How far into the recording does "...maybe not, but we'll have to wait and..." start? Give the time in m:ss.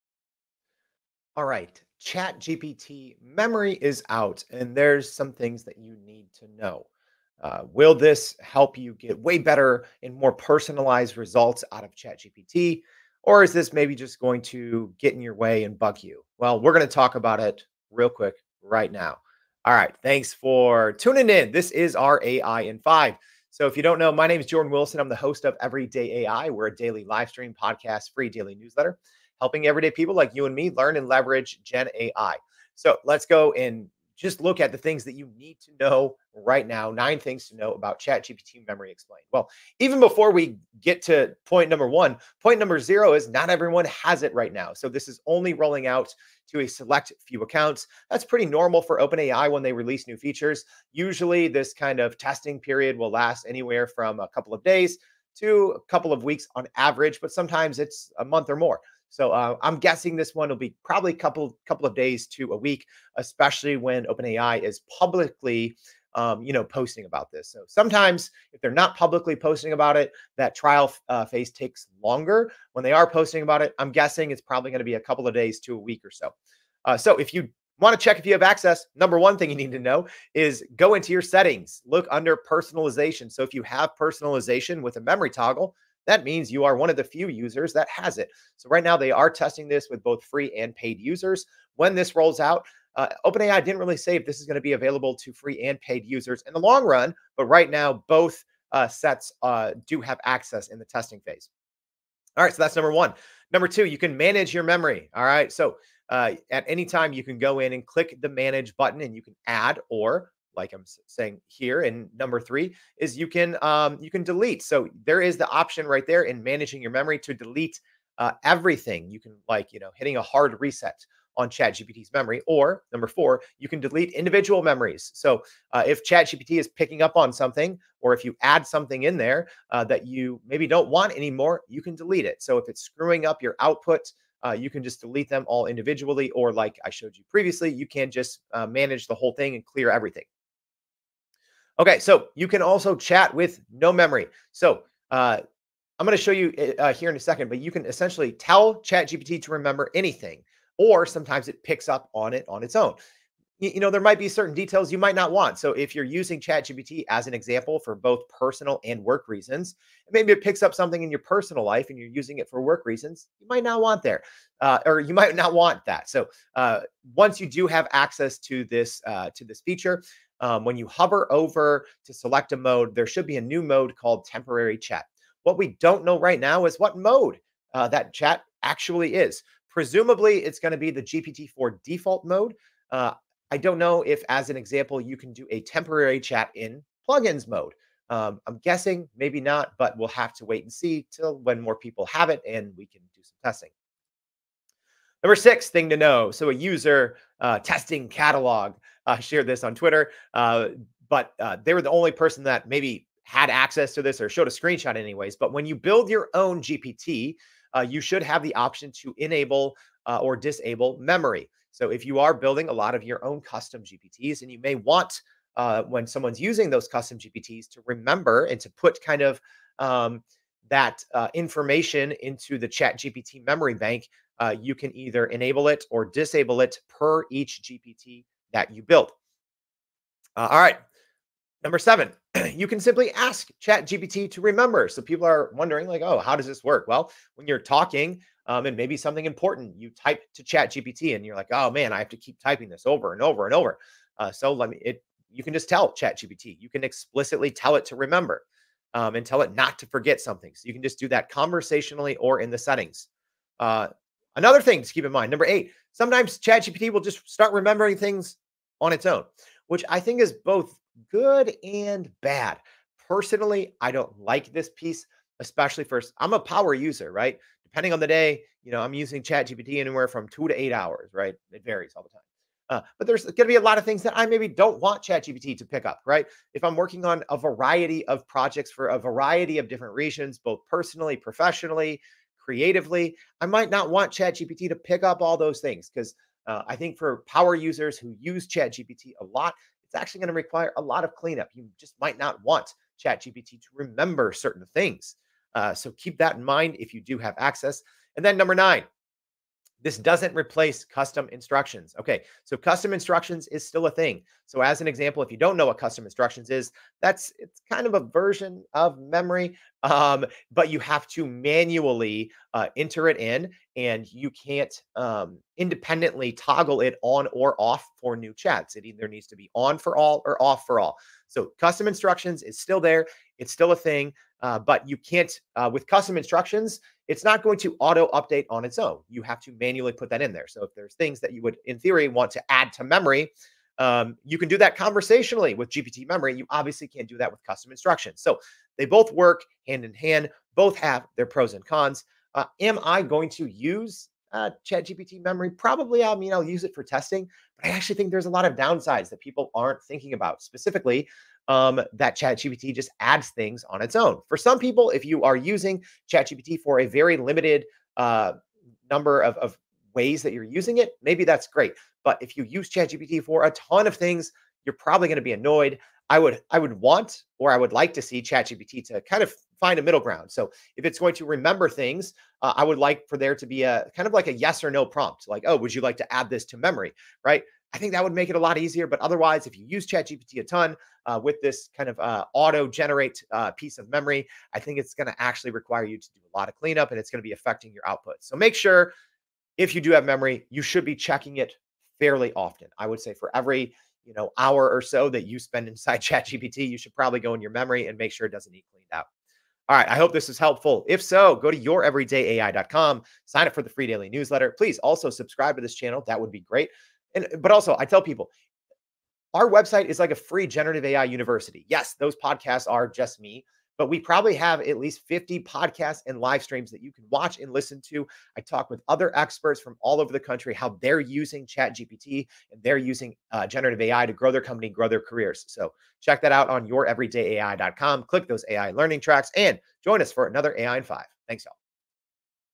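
3:09.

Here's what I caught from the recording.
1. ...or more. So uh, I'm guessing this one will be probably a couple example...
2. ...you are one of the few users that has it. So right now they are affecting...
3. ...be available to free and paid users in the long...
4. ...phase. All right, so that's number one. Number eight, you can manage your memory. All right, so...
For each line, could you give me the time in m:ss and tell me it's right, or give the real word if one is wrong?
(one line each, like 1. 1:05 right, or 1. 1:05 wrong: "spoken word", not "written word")
1. 0:58 wrong: "couple", not "example"
2. 1:26 wrong: "testing", not "affecting"
3. 1:34 right
4. 1:41 wrong: "two", not "eight".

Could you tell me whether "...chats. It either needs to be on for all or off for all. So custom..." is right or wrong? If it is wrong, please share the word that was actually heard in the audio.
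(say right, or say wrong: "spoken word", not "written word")
right.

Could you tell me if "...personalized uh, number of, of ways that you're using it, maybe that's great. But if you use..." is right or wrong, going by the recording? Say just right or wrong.
wrong.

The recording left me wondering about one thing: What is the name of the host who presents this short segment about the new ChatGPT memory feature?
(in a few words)
Jordan Wilson.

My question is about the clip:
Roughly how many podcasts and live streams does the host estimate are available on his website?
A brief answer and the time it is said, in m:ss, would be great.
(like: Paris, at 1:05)
50, at 6:55.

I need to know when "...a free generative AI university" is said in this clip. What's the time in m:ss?
6:50.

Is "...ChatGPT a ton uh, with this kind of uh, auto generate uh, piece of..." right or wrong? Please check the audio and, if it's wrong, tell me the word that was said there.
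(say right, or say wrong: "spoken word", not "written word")
right.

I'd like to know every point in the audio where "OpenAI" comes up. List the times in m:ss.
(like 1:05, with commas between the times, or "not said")
0:48, 1:04, 1:33.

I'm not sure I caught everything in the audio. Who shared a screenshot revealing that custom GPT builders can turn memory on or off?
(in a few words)
TestingCatalog.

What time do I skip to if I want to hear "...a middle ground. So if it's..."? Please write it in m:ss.
6:09.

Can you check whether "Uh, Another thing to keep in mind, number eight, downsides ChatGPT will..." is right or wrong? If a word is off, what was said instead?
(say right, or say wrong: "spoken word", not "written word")
wrong: "sometimes", not "downsides".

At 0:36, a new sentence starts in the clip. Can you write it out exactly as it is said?
Nine things to know about ChatGPT Memory Explained.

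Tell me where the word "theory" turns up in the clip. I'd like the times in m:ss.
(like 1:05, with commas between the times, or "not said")
5:31.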